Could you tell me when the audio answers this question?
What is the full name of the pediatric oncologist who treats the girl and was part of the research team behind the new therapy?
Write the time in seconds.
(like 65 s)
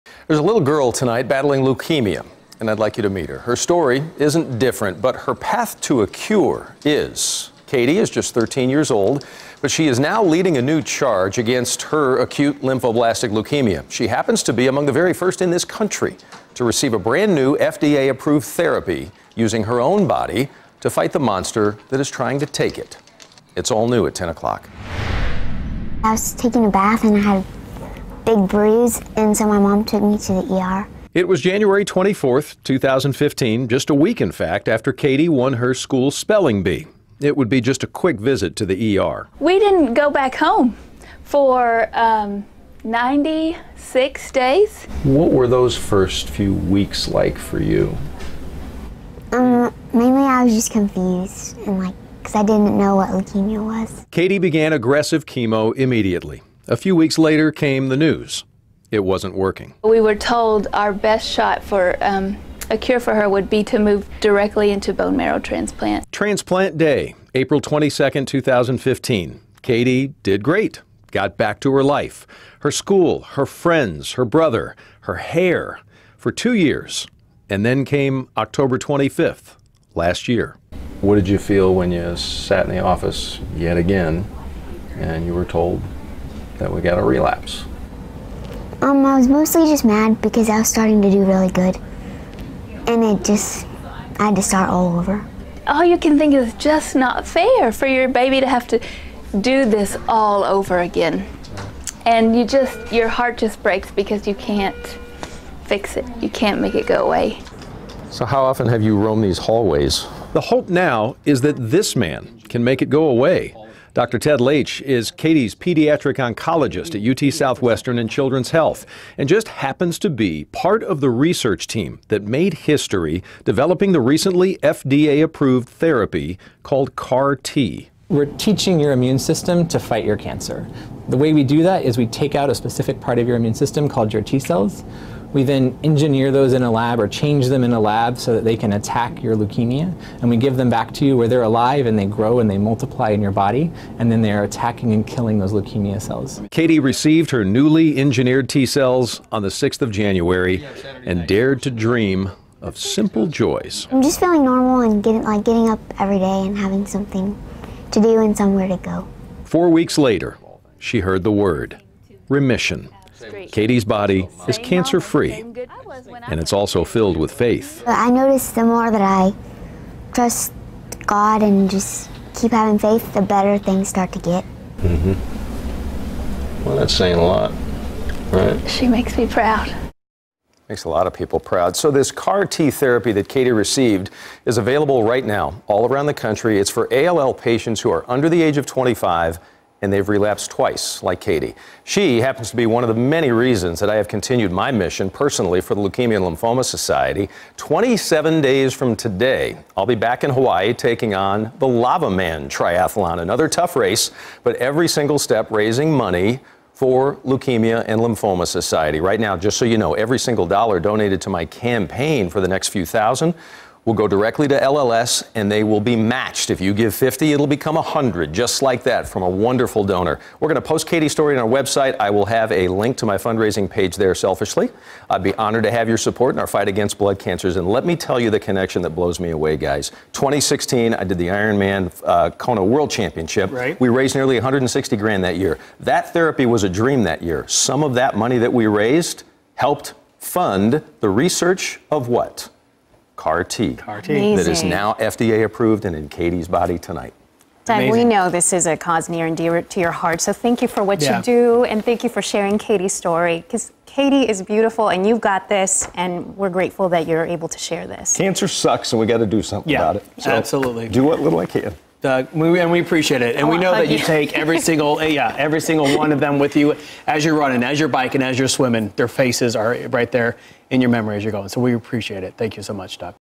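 114 s.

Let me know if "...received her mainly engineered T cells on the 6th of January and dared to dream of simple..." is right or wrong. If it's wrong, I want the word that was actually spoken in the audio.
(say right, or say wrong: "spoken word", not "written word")
wrong: "newly", not "mainly".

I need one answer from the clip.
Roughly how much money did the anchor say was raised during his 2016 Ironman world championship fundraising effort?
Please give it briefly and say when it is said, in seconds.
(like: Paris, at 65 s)
nearly $160,000, at 234 s.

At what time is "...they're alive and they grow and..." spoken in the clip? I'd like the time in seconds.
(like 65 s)
141 s.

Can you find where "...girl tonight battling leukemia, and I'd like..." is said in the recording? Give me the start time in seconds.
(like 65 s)
0 s.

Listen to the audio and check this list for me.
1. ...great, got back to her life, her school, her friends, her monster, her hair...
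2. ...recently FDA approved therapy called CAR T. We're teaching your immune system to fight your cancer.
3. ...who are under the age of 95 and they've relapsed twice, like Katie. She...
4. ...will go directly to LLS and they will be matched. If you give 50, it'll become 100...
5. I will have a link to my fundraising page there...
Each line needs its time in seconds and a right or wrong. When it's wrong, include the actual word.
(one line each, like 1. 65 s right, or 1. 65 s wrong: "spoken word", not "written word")
1. 70 s wrong: "brother", not "monster"
2. 123 s right
3. 187 s wrong: "25", not "95"
4. 213 s right
5. 221 s right.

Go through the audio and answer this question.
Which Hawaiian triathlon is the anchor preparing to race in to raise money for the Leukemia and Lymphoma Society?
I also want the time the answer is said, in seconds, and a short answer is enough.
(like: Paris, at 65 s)
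Lavaman Triathlon, at 201 s.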